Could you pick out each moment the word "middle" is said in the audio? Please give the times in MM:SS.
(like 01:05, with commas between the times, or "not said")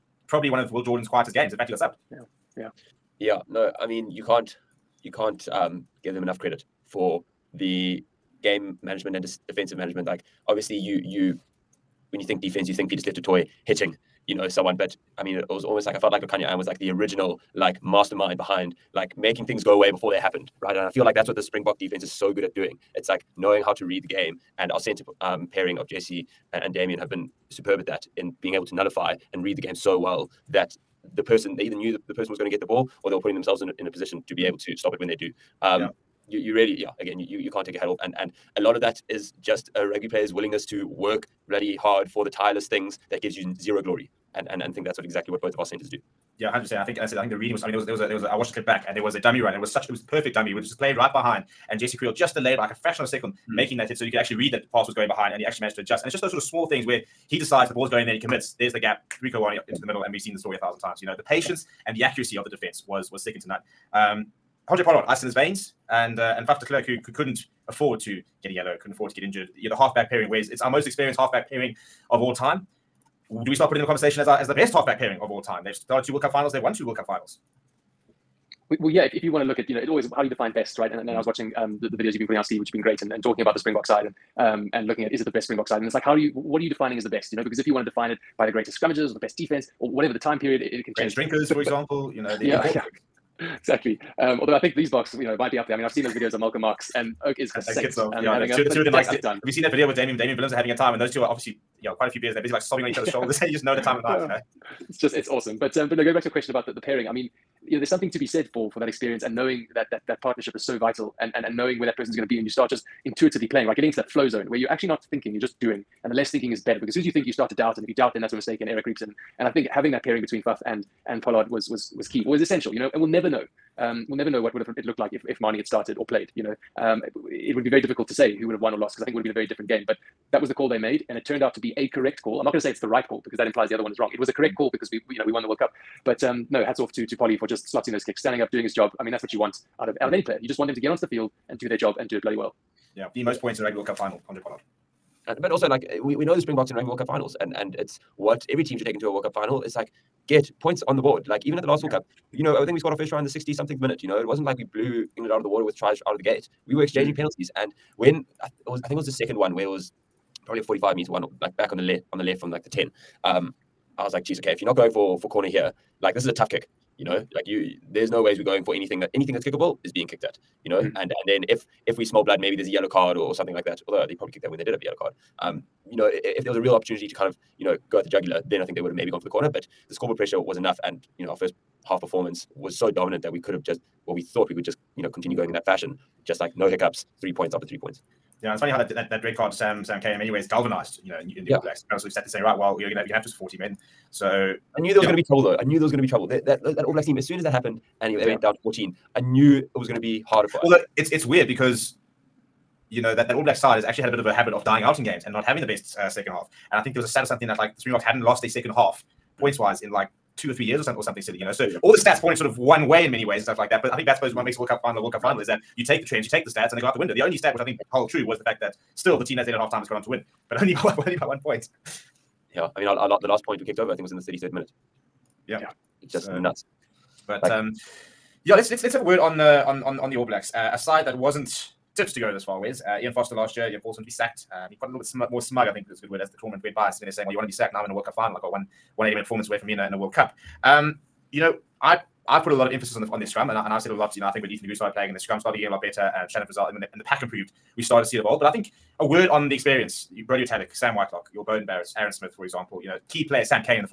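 00:59.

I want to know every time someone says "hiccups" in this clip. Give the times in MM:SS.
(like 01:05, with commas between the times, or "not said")
03:06.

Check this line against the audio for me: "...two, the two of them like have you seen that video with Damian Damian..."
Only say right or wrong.
right.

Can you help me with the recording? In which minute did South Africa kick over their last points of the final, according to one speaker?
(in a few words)
33rd minute.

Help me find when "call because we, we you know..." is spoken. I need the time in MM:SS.
02:14.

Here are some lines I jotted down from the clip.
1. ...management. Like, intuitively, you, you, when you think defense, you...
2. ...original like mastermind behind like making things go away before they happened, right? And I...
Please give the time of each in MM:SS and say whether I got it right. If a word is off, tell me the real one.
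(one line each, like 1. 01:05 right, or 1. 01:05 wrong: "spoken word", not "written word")
1. 00:09 wrong: "obviously", not "intuitively"
2. 00:16 right.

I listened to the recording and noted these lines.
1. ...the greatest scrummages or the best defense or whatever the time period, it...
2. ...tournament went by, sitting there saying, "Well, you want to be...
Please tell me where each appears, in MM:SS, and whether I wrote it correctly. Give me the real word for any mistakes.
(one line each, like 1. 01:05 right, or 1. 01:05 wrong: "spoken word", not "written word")
1. 01:28 right
2. 03:56 right.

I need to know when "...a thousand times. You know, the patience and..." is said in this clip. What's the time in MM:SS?
01:00.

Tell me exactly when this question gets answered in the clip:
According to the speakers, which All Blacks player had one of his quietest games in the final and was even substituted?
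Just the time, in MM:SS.
00:00.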